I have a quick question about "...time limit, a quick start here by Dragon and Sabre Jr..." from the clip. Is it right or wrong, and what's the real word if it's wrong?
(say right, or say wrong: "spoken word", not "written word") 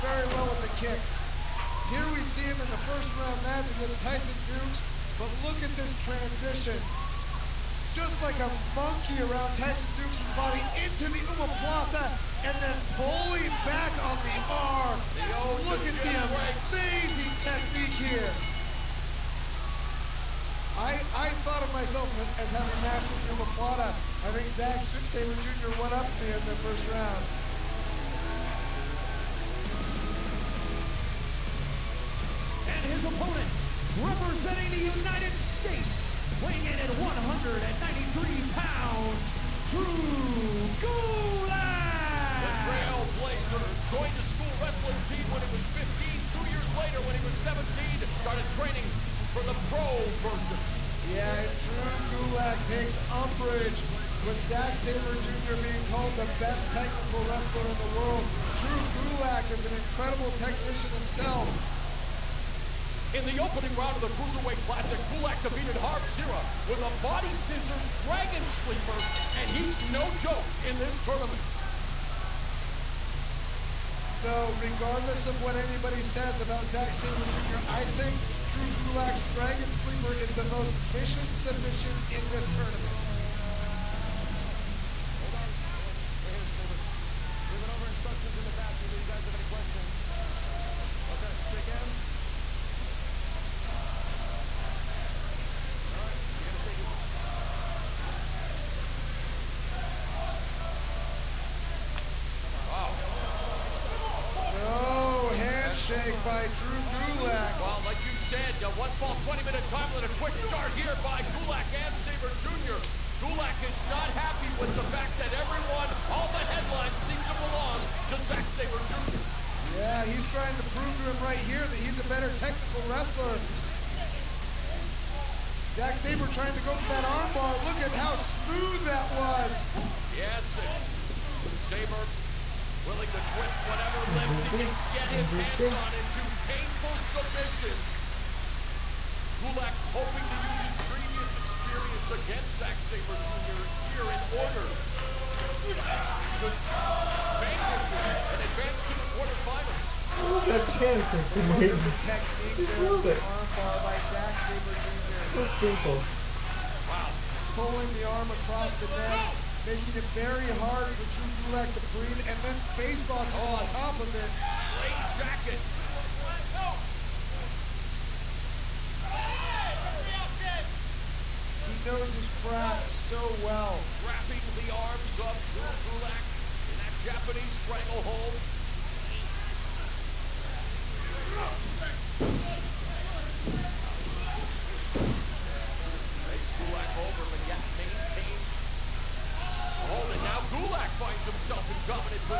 wrong: "Gulak", not "Dragon".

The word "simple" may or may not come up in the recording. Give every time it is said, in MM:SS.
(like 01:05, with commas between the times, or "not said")
02:35.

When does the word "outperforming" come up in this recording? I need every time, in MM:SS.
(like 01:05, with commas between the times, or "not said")
not said.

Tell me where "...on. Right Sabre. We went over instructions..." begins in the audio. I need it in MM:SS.
01:25.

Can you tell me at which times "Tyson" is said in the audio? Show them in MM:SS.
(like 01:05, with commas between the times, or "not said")
00:04, 00:09.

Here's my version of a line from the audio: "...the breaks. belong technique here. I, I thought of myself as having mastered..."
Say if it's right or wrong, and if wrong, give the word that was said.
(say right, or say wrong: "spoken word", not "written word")
wrong: "amazing", not "belong".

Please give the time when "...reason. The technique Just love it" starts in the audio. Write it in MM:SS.
02:31.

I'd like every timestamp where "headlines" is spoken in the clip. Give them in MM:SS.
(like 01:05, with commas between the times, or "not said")
01:56.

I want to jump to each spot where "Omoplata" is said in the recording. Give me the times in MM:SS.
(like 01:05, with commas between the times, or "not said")
00:11, 00:23.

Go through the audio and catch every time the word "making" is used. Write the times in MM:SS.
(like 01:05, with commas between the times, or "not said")
02:39.